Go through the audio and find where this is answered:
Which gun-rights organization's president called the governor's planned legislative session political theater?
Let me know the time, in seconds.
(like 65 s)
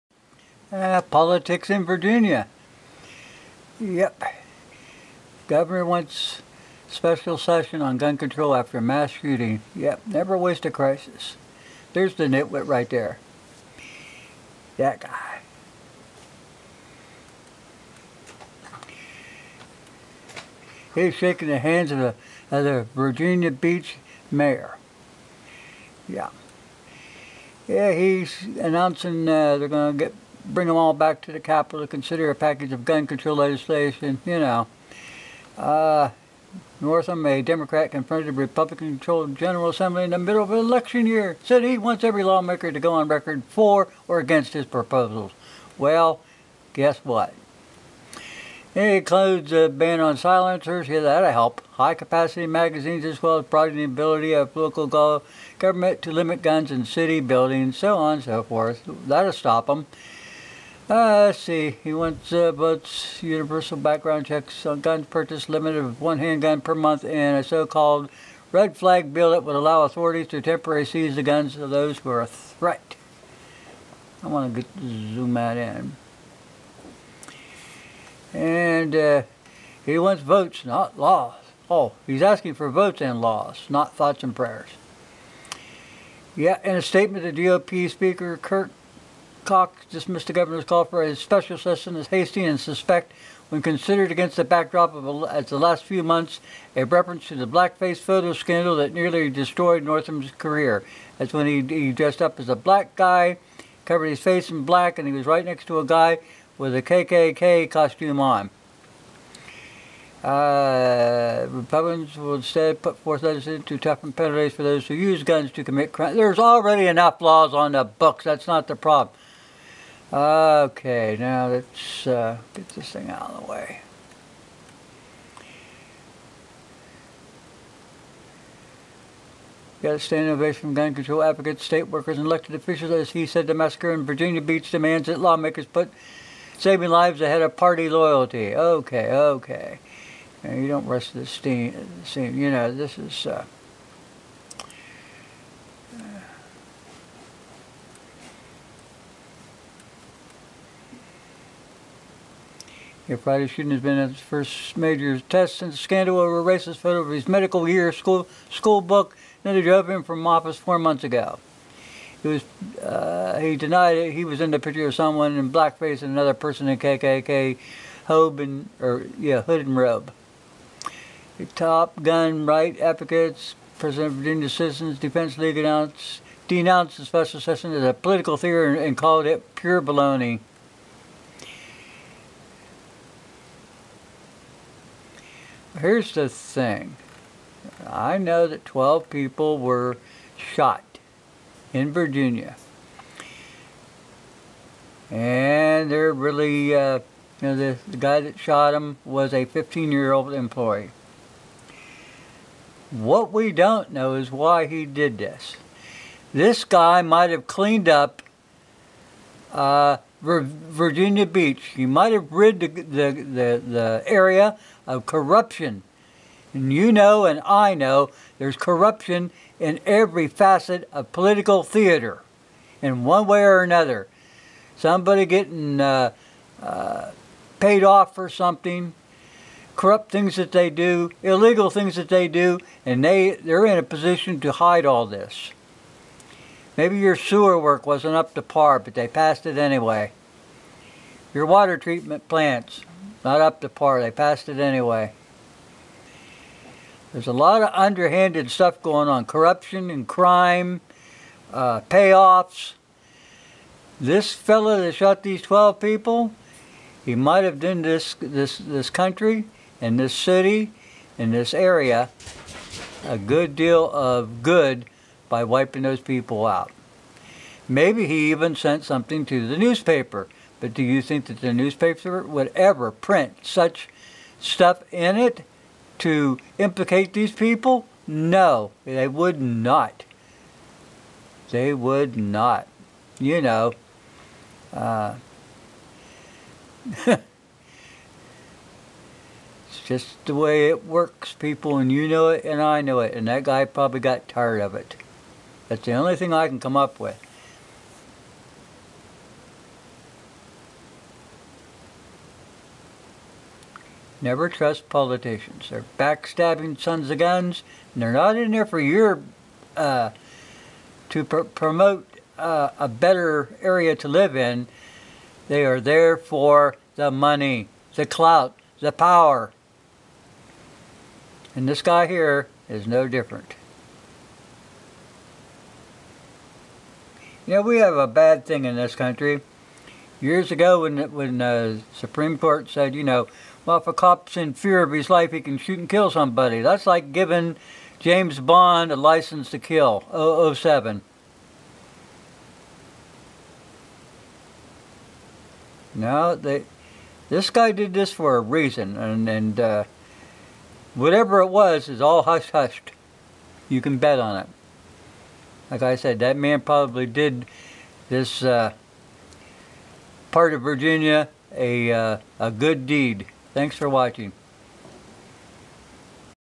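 174 s.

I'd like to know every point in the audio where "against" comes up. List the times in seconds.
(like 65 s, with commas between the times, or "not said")
44 s, 94 s.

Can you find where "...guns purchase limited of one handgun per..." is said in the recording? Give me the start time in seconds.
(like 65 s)
64 s.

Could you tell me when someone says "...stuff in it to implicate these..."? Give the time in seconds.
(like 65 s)
274 s.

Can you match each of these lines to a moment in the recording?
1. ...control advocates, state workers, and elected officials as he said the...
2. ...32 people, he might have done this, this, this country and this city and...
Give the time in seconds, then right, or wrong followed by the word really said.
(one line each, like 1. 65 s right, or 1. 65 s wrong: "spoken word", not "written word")
1. 130 s right
2. 255 s wrong: "12", not "32".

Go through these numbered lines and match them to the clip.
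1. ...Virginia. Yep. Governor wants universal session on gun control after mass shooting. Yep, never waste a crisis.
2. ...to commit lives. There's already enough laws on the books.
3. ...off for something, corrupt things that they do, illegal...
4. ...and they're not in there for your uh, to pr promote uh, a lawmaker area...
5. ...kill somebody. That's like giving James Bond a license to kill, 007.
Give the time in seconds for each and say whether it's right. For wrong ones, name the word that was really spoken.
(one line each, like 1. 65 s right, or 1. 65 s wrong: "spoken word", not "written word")
1. 1 s wrong: "special", not "universal"
2. 115 s wrong: "crimes", not "lives"
3. 227 s right
4. 307 s wrong: "better", not "lawmaker"
5. 335 s right.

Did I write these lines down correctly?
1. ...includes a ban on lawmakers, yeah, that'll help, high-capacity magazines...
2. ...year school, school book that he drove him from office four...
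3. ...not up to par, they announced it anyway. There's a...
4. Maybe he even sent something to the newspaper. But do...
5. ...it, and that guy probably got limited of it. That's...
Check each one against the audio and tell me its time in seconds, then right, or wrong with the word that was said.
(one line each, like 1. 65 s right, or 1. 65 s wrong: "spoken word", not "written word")
1. 48 s wrong: "silencers", not "lawmakers"
2. 157 s right
3. 243 s wrong: "passed", not "announced"
4. 267 s right
5. 292 s wrong: "tired", not "limited".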